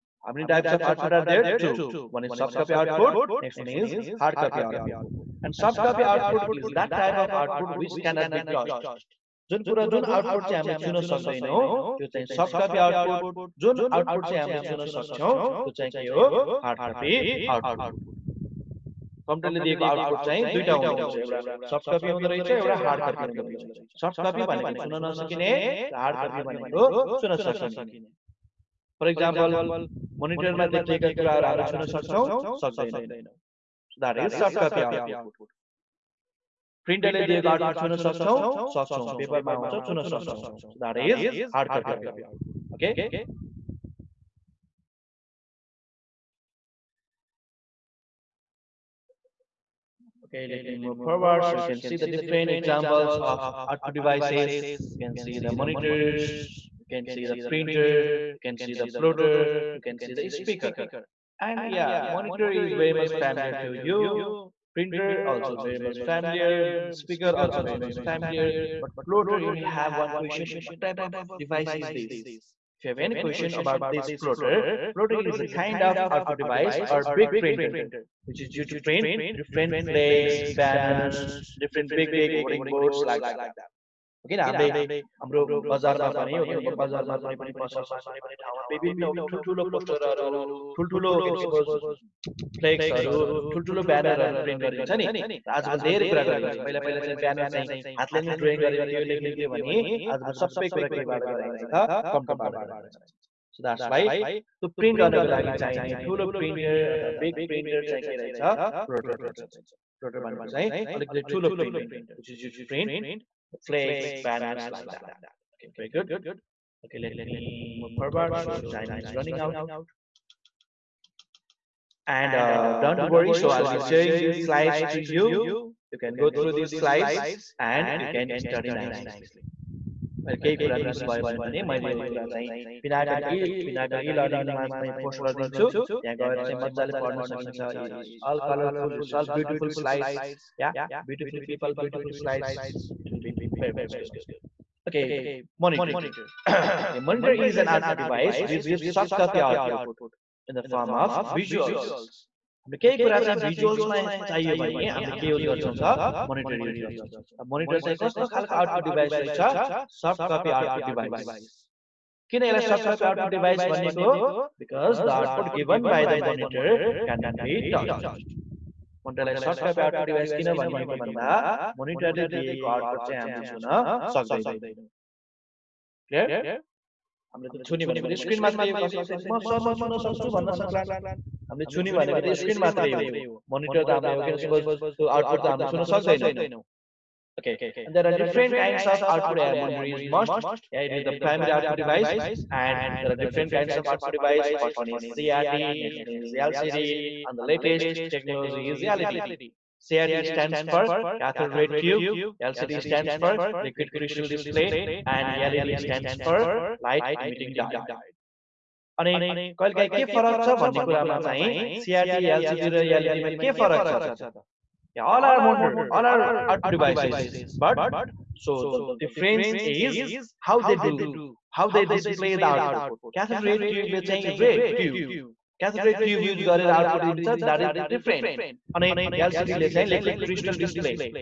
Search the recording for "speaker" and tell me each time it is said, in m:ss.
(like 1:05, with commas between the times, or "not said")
1:00, 1:07.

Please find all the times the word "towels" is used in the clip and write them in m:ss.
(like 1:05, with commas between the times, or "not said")
not said.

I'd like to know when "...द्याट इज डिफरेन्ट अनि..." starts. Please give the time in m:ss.
3:47.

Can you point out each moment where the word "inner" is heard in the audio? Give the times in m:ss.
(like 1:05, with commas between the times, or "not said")
not said.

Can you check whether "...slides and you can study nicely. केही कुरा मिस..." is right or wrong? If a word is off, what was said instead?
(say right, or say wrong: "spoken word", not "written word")
right.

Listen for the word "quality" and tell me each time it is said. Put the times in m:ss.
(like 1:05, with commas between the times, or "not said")
not said.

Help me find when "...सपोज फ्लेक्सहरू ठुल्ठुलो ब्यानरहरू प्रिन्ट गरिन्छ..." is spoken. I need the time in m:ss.
1:31.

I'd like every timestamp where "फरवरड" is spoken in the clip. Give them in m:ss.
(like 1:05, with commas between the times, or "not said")
1:58.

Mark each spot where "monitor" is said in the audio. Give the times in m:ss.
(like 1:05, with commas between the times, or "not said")
0:55, 1:02, 3:03, 3:09.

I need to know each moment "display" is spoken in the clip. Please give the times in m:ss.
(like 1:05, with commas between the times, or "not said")
3:24.